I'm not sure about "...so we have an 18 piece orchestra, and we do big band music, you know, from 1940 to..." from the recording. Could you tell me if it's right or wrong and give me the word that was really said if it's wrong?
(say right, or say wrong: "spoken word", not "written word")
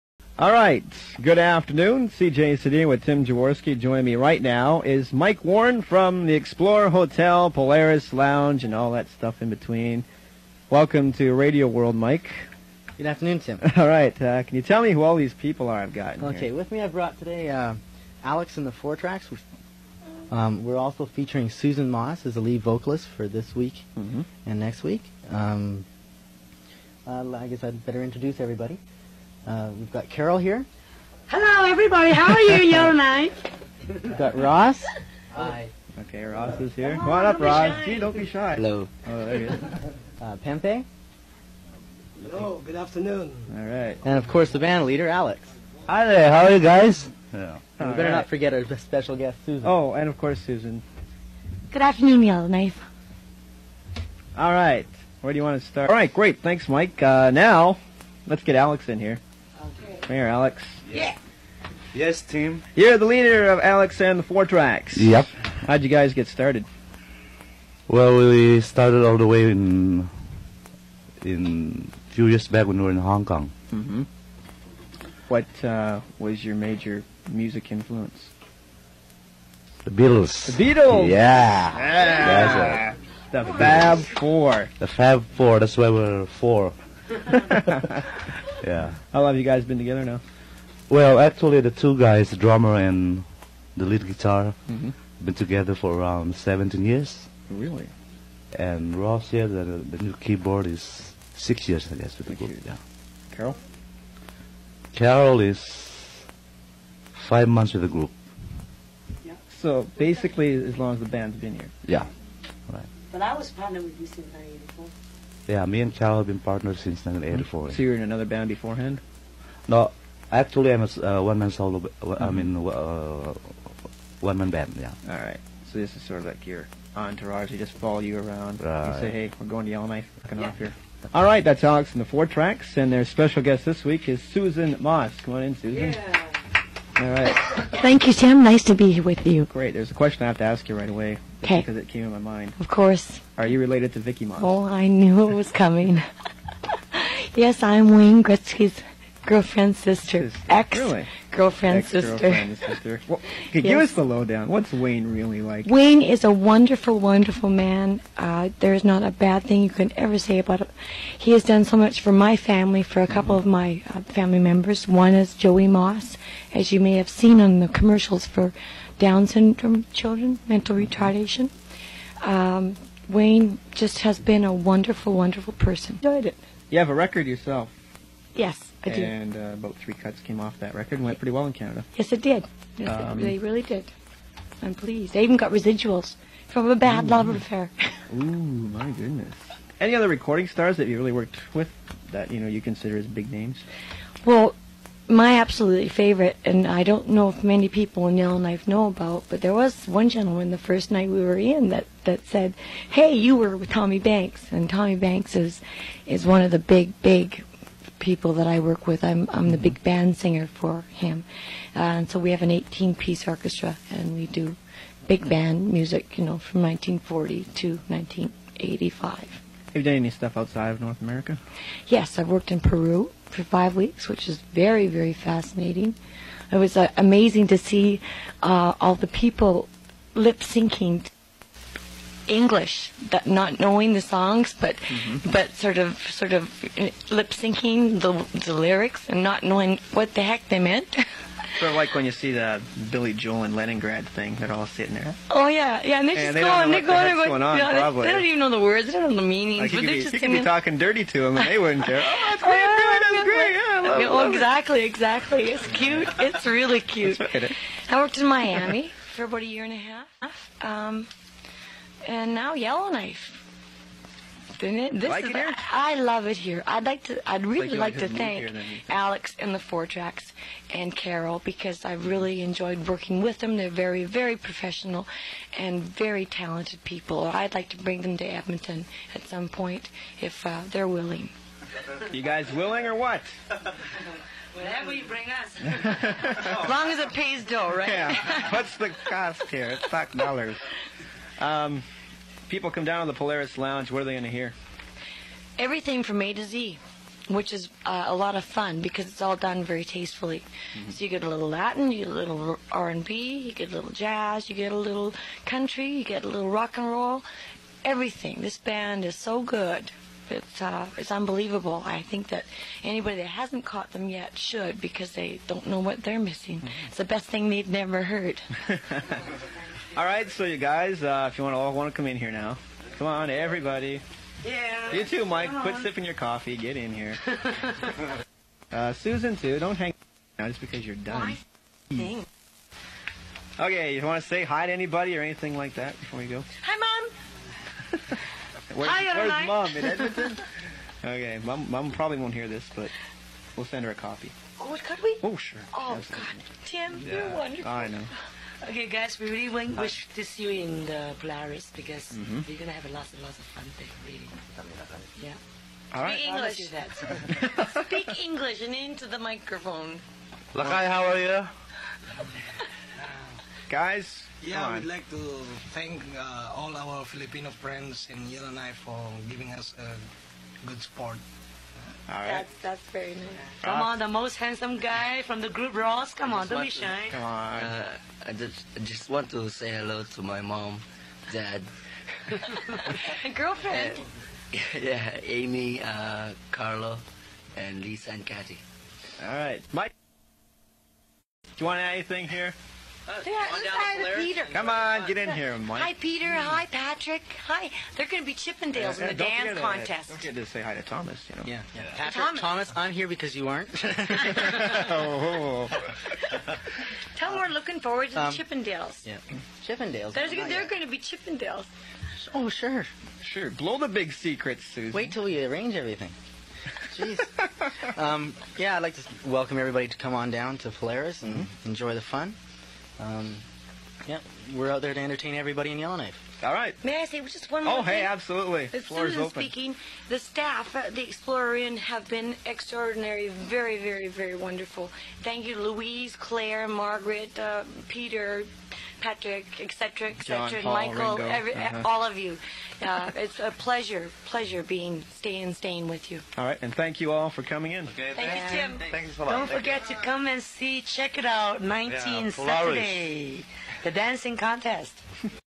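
right.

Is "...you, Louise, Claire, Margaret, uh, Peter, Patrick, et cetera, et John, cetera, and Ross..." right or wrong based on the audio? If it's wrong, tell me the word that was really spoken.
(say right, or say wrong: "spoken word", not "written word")
wrong: "Paul", not "Ross".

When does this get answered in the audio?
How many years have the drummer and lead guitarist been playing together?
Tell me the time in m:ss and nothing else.
1:36.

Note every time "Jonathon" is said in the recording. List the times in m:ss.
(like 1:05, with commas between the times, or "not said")
not said.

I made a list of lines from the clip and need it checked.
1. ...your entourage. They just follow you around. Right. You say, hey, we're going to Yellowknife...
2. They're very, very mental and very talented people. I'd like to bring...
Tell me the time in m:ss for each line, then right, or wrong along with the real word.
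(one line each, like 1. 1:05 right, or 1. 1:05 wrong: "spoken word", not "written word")
1. 2:06 right
2. 4:33 wrong: "professional", not "mental".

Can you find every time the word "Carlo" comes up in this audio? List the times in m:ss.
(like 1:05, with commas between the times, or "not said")
6:26.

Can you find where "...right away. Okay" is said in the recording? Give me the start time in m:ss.
2:20.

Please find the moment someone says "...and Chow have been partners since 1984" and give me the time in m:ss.
1:55.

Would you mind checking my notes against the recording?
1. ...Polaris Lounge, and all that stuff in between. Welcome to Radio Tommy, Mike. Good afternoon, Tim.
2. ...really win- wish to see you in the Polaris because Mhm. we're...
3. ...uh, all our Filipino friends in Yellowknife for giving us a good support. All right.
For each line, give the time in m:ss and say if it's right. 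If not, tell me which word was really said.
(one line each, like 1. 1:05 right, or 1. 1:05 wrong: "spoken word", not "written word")
1. 0:07 wrong: "World", not "Tommy"
2. 5:49 right
3. 6:06 right.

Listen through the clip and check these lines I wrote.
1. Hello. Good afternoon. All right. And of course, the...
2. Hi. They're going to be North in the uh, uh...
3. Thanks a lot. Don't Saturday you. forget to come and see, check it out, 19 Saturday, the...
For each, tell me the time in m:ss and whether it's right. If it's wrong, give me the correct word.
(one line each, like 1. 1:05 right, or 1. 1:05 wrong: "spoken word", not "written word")
1. 0:42 right
2. 6:37 wrong: "Chippendales", not "North"
3. 7:28 wrong: "Thank", not "Saturday".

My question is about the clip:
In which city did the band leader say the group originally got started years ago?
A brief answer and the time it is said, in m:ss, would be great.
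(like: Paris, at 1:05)
Hong Kong, at 1:12.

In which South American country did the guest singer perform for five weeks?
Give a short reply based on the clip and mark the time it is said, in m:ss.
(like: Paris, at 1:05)
Peru, at 3:42.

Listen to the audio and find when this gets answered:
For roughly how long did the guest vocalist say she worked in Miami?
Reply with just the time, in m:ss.
4:19.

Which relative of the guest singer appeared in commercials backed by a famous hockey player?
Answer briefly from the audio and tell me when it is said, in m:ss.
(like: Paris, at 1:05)
Joey Moss, at 2:45.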